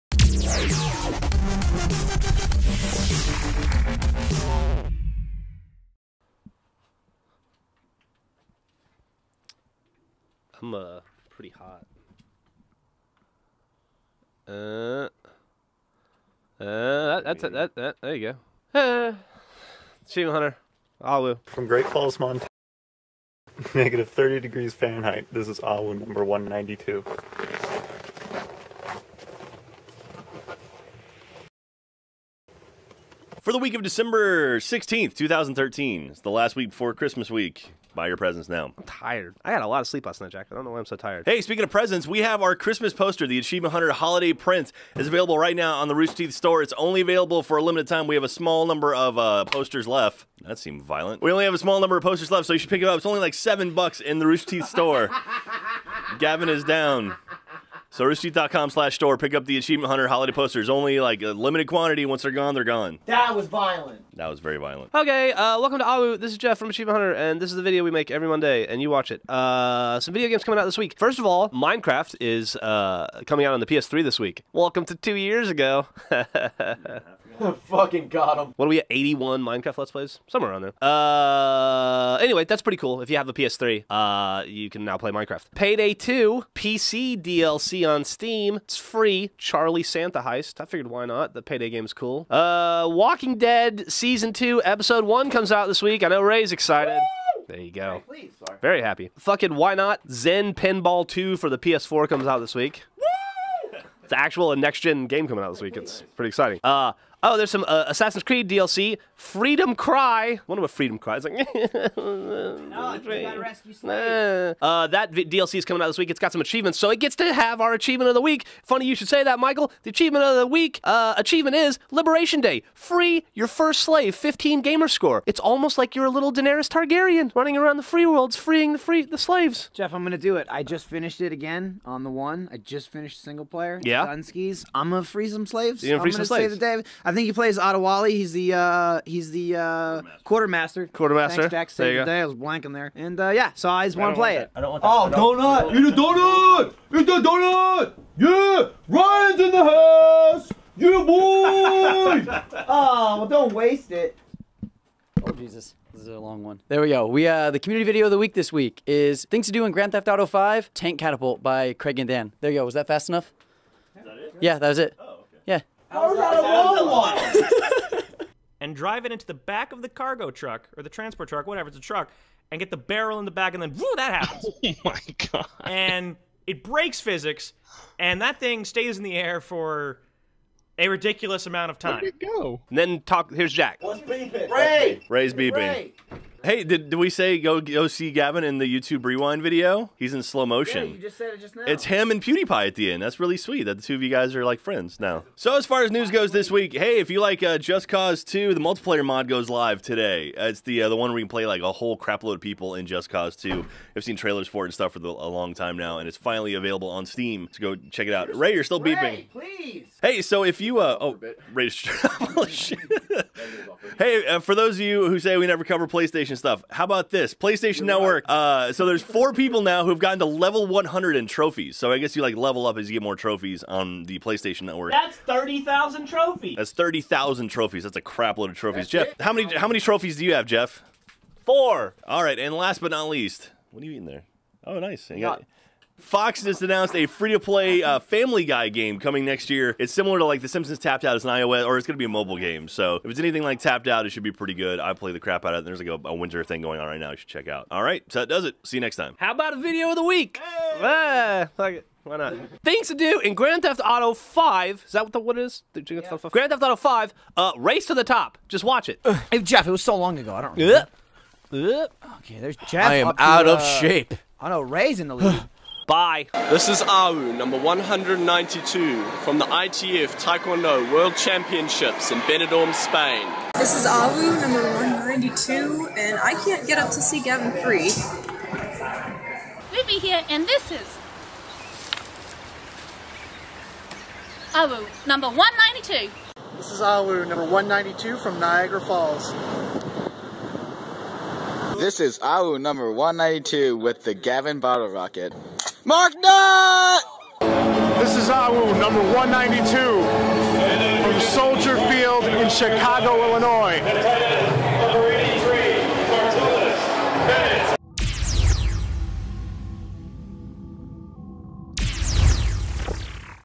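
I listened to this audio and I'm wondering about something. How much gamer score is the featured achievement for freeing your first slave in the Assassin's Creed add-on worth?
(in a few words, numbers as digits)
15.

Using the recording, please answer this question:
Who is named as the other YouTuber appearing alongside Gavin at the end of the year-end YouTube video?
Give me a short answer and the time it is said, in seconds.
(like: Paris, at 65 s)
PewDiePie, at 192 s.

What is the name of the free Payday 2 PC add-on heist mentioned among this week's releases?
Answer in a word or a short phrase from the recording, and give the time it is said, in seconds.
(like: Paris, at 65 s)
Charlie Santa Heist, at 89 s.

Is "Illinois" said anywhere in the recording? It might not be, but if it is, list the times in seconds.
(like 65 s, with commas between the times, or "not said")
303 s.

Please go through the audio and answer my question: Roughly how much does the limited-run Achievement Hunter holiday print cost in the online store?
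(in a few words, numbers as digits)
7 bucks.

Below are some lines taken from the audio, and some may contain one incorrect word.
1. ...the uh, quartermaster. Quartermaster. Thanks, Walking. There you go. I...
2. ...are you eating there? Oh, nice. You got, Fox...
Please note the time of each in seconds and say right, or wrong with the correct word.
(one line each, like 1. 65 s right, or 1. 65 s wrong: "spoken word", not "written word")
1. 139 s wrong: "Jack", not "Walking"
2. 233 s right.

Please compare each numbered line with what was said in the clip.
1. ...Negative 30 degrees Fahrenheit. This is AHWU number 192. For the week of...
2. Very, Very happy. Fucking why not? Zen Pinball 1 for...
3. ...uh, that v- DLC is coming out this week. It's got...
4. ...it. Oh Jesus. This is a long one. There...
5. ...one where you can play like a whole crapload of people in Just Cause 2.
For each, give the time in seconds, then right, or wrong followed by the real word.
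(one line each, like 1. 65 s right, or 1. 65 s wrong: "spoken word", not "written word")
1. 23 s right
2. 98 s wrong: "2", not "1"
3. 114 s right
4. 153 s right
5. 200 s right.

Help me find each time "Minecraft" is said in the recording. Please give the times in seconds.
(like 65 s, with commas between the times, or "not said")
71 s, 79 s, 85 s.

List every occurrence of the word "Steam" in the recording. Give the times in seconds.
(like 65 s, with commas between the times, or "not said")
88 s, 207 s.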